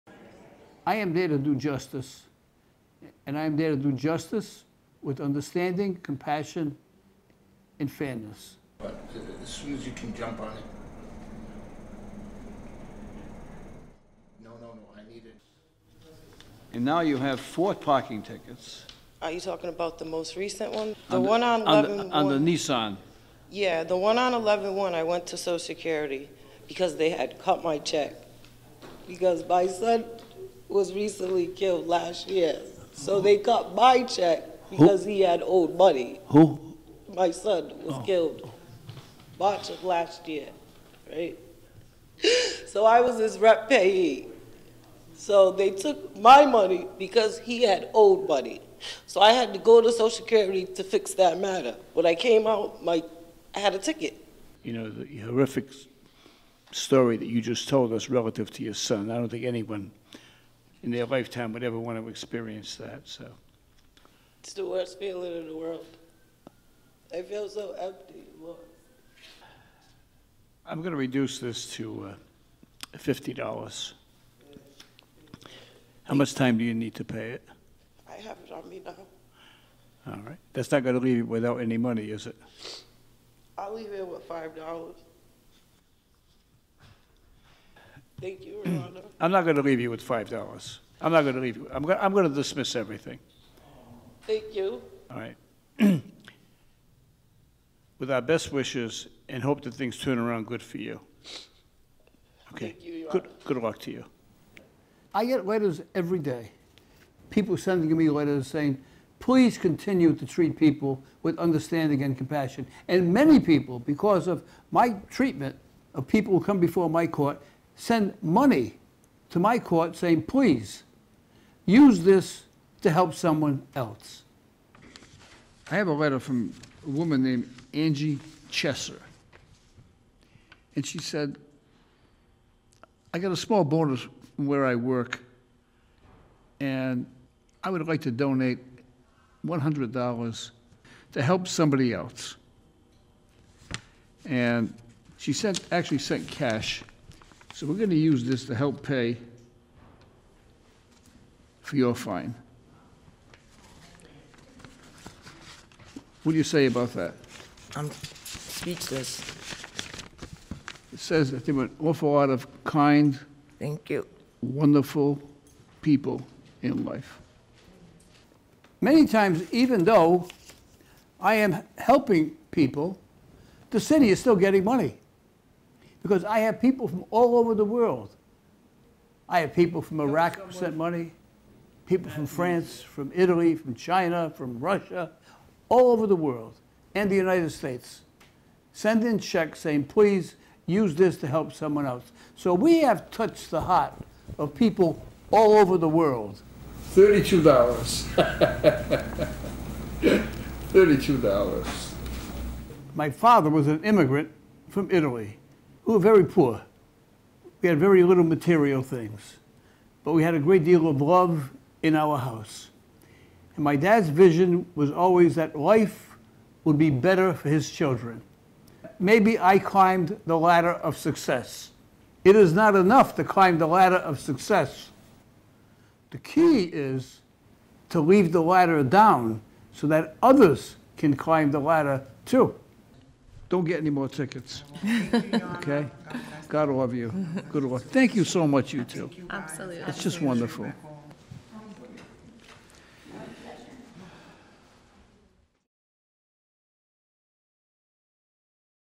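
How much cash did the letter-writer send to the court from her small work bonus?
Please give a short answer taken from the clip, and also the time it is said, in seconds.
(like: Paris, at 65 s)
$100, at 139 s.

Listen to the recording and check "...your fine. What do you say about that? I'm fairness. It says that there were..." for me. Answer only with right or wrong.
wrong.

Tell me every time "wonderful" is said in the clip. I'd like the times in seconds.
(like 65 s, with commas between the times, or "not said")
164 s, 240 s.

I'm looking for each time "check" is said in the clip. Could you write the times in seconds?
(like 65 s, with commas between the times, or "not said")
27 s, 34 s, 189 s.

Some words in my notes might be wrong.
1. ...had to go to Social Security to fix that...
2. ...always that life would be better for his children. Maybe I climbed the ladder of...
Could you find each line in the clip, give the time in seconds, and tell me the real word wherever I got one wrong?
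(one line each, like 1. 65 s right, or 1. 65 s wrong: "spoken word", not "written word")
1. 49 s right
2. 214 s right.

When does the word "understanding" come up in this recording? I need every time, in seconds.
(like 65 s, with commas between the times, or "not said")
5 s, 111 s.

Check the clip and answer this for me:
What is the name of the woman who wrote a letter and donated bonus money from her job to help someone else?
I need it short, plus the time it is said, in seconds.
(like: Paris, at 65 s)
Angie Chesser, at 127 s.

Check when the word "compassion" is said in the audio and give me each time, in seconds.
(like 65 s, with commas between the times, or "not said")
6 s, 112 s.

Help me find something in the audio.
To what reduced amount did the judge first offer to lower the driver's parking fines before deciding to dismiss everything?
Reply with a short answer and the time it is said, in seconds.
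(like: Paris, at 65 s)
$50, at 72 s.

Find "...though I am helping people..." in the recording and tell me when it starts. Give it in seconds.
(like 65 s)
169 s.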